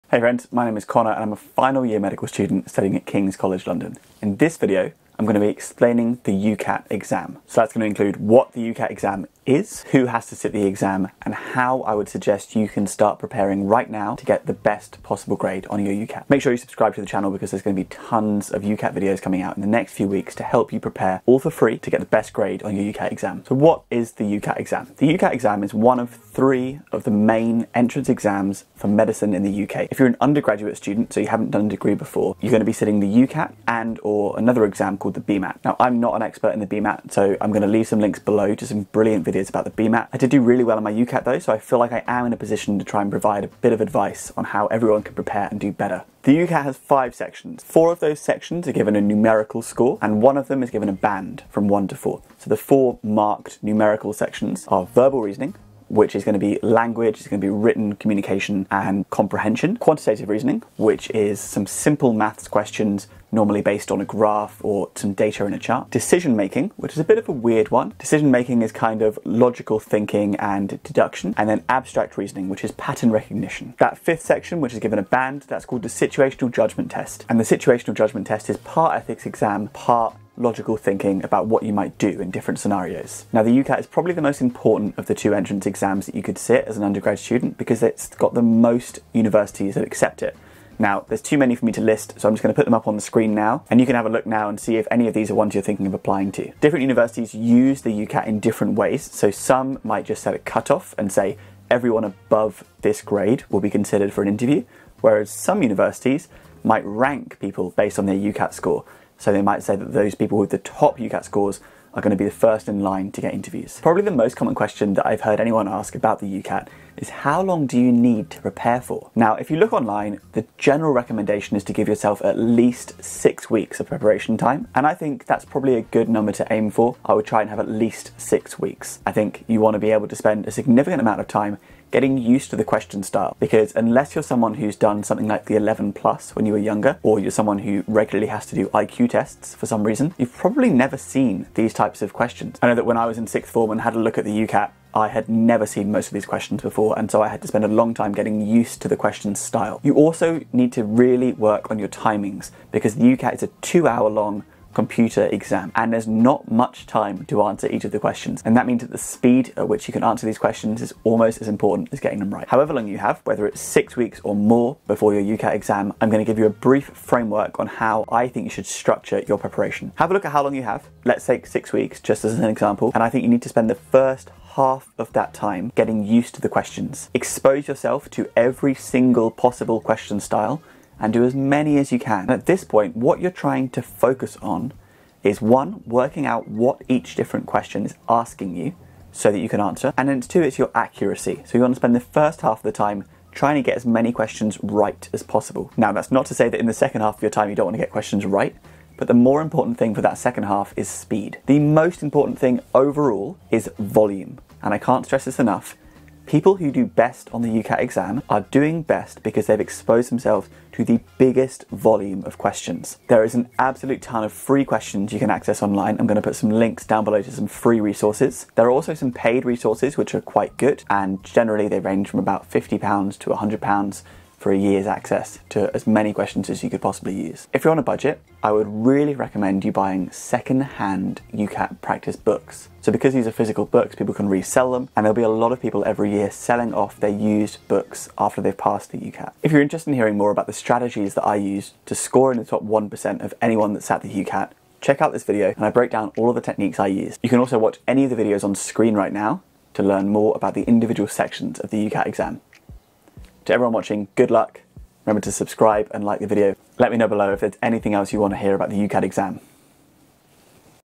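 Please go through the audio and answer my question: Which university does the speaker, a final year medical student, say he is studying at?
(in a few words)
King's College London.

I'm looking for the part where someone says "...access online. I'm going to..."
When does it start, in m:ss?
3:35.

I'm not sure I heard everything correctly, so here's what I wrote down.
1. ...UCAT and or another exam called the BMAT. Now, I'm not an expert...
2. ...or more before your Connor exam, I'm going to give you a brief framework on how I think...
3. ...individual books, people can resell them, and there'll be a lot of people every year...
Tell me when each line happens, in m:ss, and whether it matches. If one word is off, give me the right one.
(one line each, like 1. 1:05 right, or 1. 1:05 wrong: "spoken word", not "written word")
1. 0:33 right
2. 2:44 wrong: "UCAT", not "Connor"
3. 3:53 wrong: "physical", not "individual".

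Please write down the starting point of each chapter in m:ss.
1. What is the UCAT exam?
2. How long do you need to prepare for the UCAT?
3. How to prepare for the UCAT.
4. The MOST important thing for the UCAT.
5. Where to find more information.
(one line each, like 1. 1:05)
1. 0:23
2. 1:53
3. 2:42
4. 3:21
5. 3:59.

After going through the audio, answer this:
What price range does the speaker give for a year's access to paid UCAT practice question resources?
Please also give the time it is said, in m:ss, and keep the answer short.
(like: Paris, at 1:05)
£50 to £100, at 3:42.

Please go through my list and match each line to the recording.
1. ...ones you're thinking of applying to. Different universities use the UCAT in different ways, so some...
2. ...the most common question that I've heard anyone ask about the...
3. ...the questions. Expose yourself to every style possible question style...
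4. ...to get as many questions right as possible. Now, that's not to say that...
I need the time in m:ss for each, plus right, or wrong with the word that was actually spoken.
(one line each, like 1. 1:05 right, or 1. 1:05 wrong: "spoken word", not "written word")
1. 1:35 right
2. 1:54 right
3. 2:56 wrong: "single", not "style"
4. 3:13 right.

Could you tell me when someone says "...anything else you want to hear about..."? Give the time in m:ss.
4:17.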